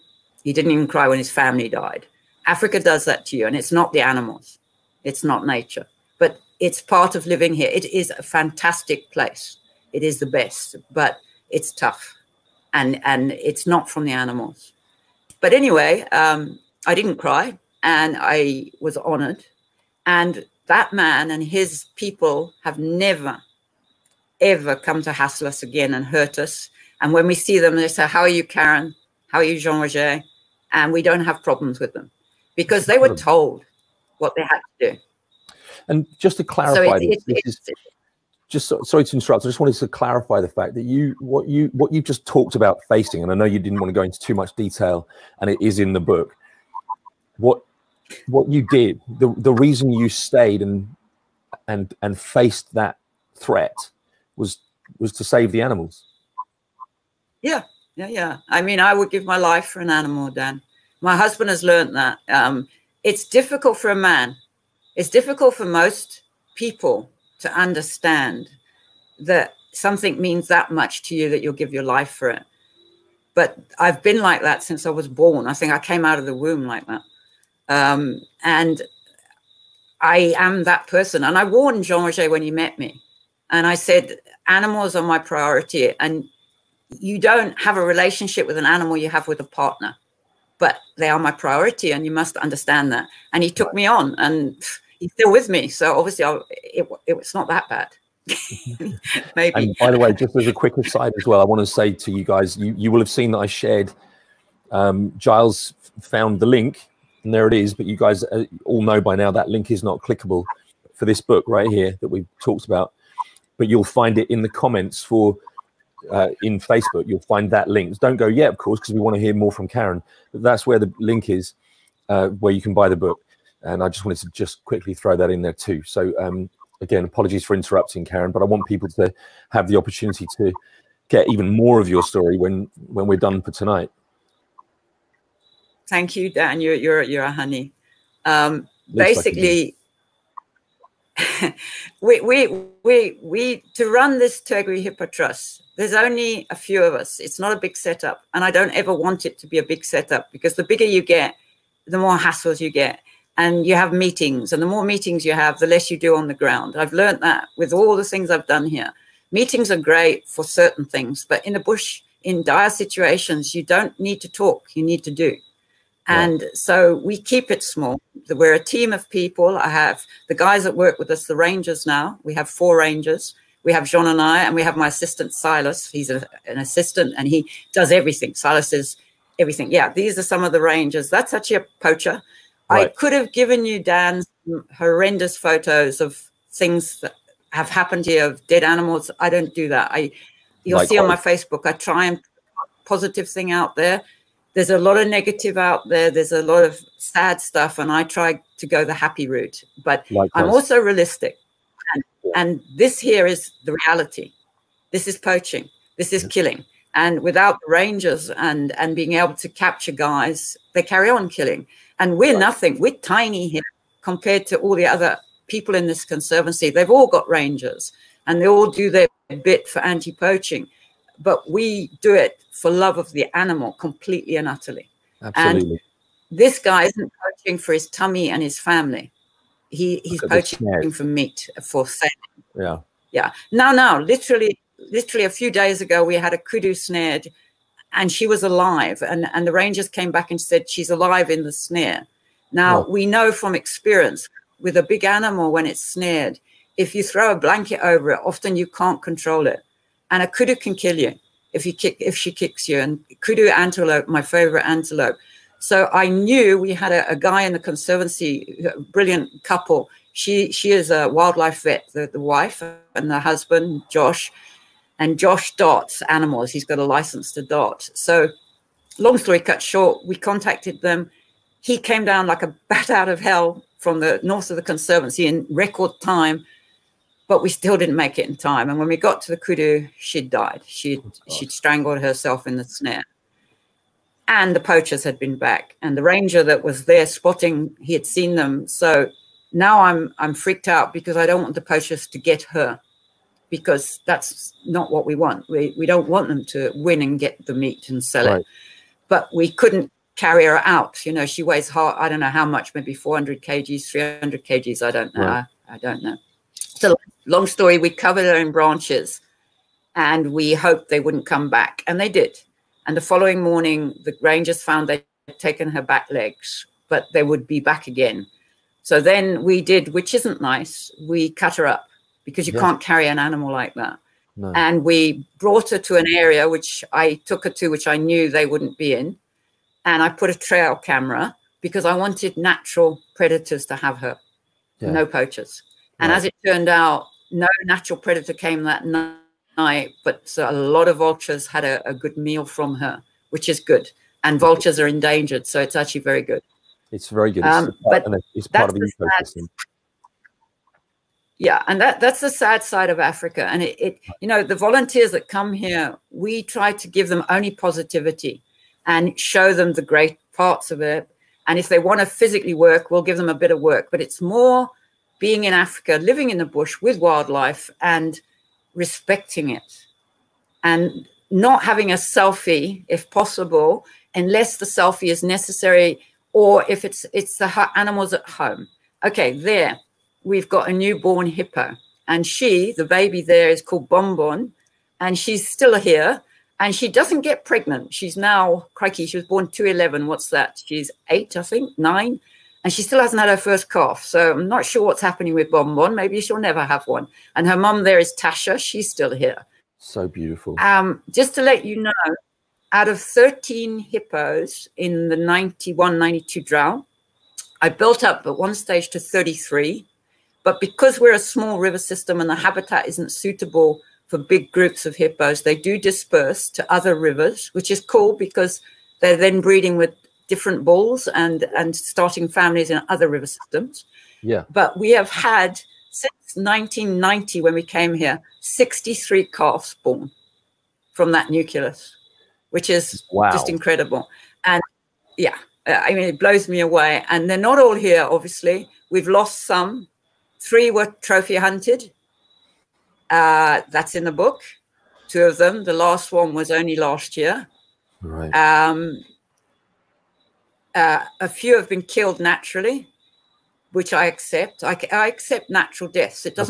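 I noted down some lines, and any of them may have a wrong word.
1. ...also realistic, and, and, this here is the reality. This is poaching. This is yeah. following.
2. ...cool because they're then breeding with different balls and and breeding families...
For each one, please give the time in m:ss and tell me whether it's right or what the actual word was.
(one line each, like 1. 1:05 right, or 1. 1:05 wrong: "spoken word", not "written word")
1. 3:20 wrong: "killing", not "following"
2. 6:57 wrong: "starting", not "breeding".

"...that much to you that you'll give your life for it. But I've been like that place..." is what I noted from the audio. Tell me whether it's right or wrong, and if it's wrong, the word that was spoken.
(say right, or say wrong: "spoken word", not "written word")
wrong: "since", not "place".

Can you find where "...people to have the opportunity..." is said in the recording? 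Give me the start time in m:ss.
2:08.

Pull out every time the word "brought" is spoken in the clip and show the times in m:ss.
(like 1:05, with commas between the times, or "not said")
5:25.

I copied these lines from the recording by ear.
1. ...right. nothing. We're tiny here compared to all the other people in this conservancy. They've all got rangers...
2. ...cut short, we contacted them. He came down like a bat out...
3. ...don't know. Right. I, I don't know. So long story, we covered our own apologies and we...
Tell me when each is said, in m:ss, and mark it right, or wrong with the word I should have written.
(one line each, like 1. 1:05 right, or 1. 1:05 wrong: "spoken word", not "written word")
1. 3:32 right
2. 4:29 right
3. 5:04 wrong: "branches", not "apologies".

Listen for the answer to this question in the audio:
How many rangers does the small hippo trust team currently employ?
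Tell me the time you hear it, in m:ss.
2:52.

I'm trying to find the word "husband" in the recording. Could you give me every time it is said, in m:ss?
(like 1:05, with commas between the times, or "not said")
1:01, 4:23.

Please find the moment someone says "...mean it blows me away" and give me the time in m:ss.
7:15.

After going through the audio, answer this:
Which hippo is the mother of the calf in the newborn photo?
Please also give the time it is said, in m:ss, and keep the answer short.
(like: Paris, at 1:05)
Tasha, at 6:37.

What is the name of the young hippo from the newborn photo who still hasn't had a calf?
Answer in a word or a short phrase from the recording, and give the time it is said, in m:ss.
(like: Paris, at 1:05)
Bonbon, at 6:23.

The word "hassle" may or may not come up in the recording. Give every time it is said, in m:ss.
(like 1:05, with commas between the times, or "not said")
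0:25, 2:32.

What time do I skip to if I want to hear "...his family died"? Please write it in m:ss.
0:01.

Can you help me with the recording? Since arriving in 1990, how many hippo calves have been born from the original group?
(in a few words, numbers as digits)
63.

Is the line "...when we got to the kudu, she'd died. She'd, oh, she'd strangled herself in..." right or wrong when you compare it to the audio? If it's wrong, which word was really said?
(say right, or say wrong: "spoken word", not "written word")
right.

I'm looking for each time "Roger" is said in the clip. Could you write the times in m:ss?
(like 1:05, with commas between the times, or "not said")
0:29, 1:22.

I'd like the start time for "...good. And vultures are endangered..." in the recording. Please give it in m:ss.
5:43.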